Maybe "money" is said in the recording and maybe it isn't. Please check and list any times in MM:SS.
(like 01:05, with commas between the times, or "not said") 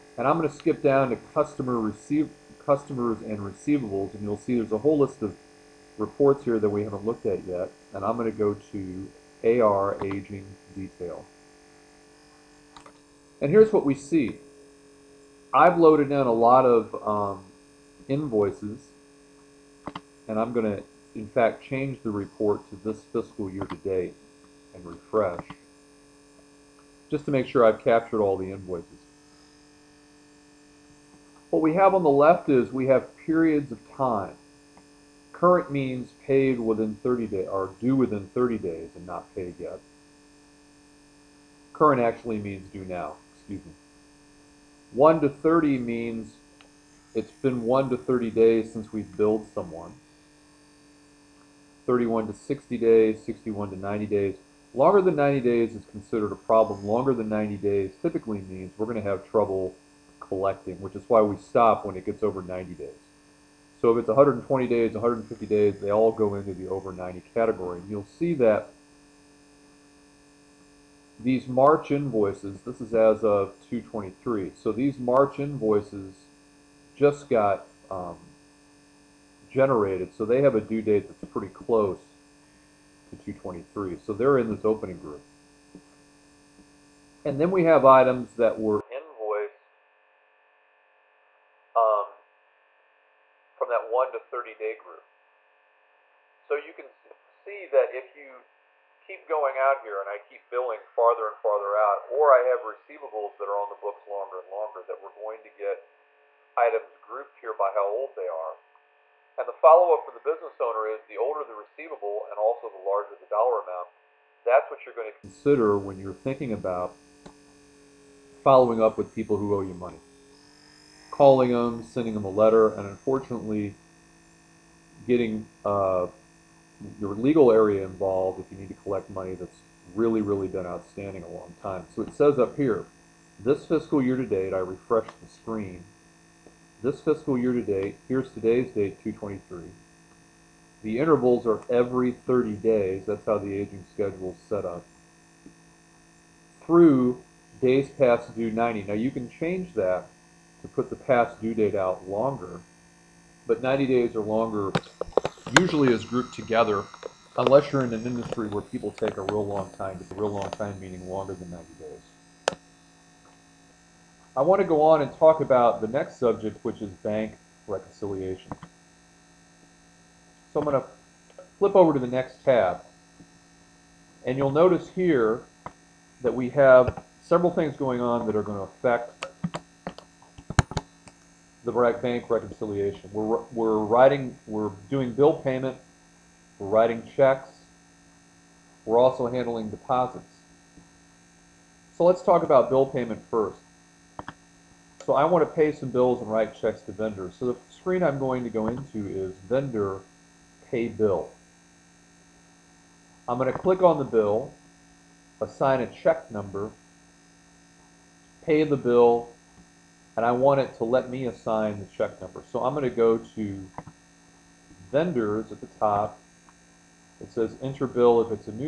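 01:59, 02:09.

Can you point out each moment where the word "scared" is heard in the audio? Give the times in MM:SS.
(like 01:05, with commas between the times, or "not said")
not said.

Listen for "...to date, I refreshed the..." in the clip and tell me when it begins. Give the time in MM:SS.
02:14.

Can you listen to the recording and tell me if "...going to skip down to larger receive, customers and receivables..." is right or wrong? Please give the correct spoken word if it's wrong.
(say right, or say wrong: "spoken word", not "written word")
wrong: "customer", not "larger".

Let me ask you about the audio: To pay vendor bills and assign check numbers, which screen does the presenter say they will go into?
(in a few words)
Vendor Pay Bill.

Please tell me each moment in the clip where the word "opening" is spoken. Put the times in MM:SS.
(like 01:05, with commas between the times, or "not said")
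01:24.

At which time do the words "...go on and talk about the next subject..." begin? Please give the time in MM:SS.
02:44.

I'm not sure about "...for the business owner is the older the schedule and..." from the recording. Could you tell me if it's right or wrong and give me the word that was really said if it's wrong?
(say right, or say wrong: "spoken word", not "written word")
wrong: "receivable", not "schedule".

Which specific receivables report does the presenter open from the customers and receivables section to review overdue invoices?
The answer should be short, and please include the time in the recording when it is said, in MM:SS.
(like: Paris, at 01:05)
AR aging detail, at 00:09.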